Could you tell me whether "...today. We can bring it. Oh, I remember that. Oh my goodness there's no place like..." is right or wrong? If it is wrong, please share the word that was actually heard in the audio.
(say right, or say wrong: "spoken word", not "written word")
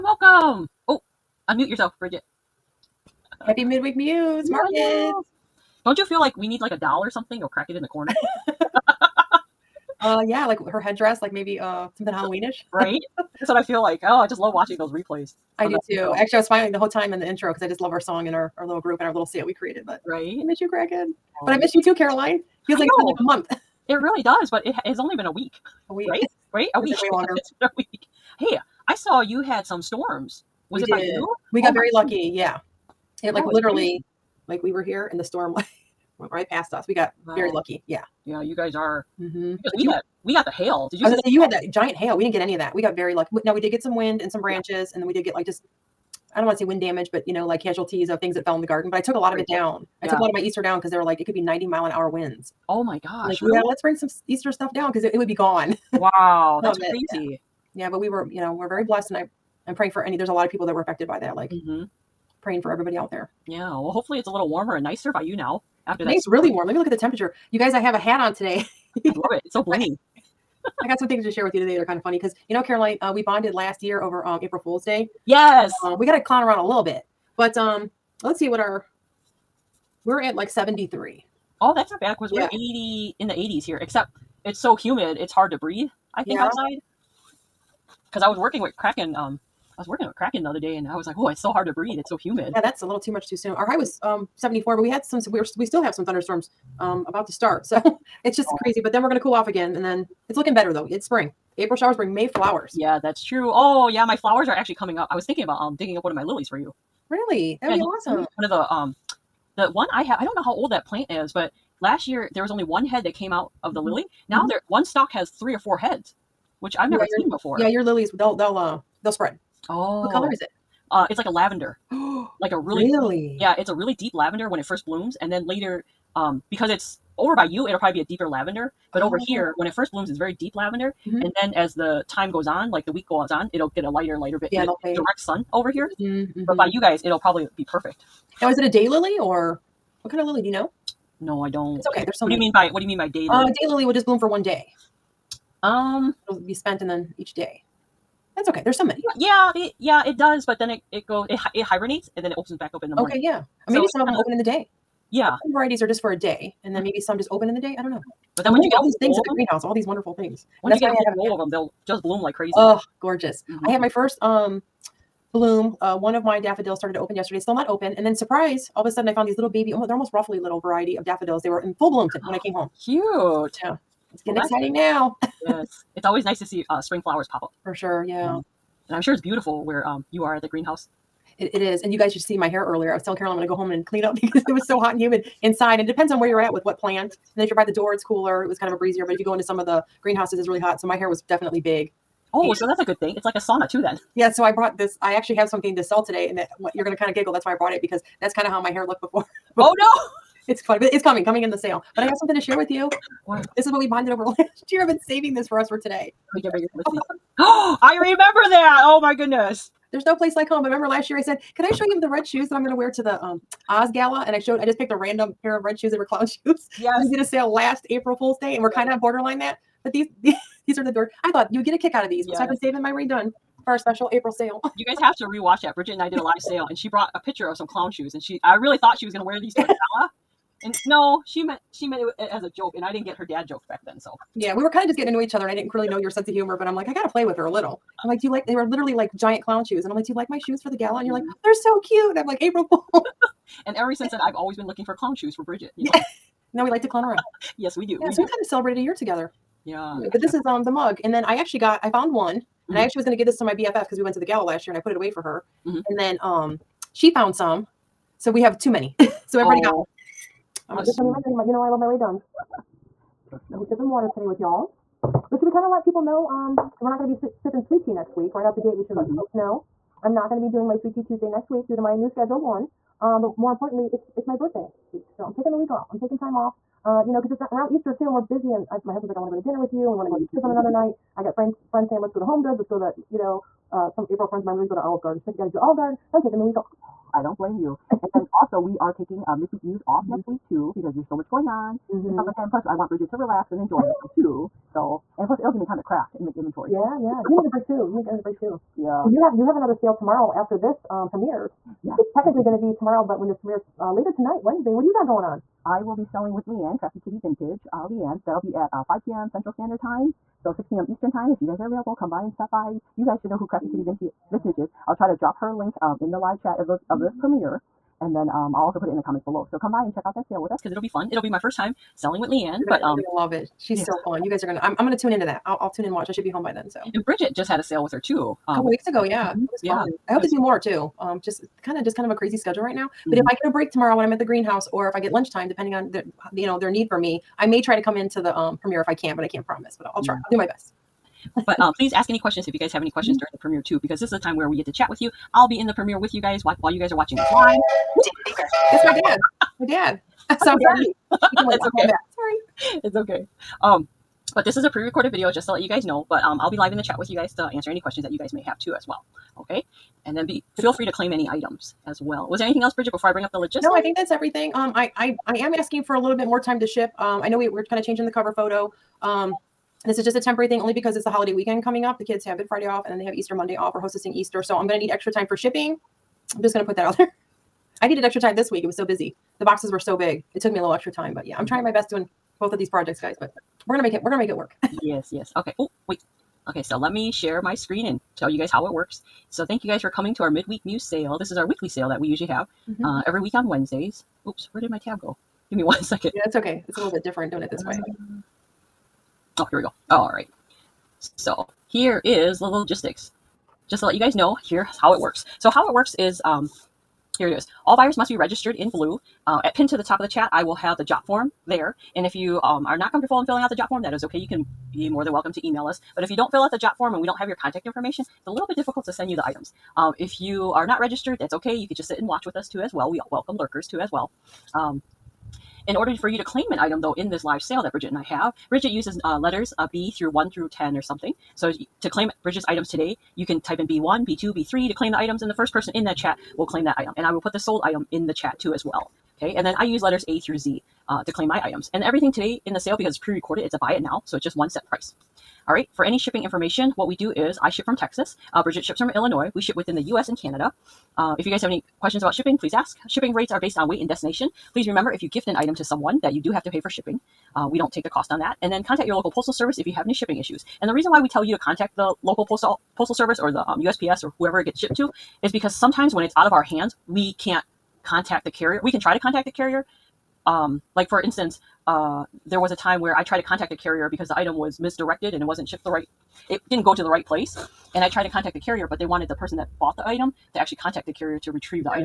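right.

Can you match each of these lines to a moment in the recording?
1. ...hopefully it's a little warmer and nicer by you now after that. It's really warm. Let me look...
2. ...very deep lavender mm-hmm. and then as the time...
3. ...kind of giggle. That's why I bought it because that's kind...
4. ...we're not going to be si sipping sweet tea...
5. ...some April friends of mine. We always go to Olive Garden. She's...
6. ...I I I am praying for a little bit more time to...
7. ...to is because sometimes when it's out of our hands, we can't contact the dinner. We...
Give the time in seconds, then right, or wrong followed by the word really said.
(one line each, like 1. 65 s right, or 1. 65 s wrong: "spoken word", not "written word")
1. 63 s right
2. 130 s right
3. 196 s wrong: "brought", not "bought"
4. 266 s right
5. 283 s right
6. 364 s wrong: "asking", not "praying"
7. 464 s wrong: "carrier", not "dinner".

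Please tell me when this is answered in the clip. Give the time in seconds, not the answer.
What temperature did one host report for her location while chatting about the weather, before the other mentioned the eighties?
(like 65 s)
80 s.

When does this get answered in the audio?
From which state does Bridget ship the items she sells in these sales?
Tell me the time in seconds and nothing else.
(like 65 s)
448 s.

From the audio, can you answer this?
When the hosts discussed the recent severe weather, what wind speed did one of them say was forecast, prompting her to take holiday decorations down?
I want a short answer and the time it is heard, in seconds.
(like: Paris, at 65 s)
90 mph, at 51 s.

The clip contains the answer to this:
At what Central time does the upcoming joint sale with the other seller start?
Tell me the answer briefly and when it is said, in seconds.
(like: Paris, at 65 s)
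5 p.m., at 308 s.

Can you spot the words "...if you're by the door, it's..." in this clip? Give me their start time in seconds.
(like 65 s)
187 s.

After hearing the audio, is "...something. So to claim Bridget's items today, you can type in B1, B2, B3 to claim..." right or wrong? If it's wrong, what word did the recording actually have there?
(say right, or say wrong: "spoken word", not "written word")
right.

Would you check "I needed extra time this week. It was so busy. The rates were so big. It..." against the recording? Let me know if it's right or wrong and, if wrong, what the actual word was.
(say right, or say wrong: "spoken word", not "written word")
wrong: "boxes", not "rates".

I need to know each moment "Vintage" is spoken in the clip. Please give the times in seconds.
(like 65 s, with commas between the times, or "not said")
307 s, 314 s.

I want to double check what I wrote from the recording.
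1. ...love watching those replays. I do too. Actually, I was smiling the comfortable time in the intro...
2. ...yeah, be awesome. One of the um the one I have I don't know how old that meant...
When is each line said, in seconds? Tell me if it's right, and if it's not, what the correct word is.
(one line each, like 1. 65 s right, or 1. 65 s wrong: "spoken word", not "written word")
1. 14 s wrong: "whole", not "comfortable"
2. 107 s wrong: "plant", not "meant".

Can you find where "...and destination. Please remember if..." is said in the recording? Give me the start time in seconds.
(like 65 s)
453 s.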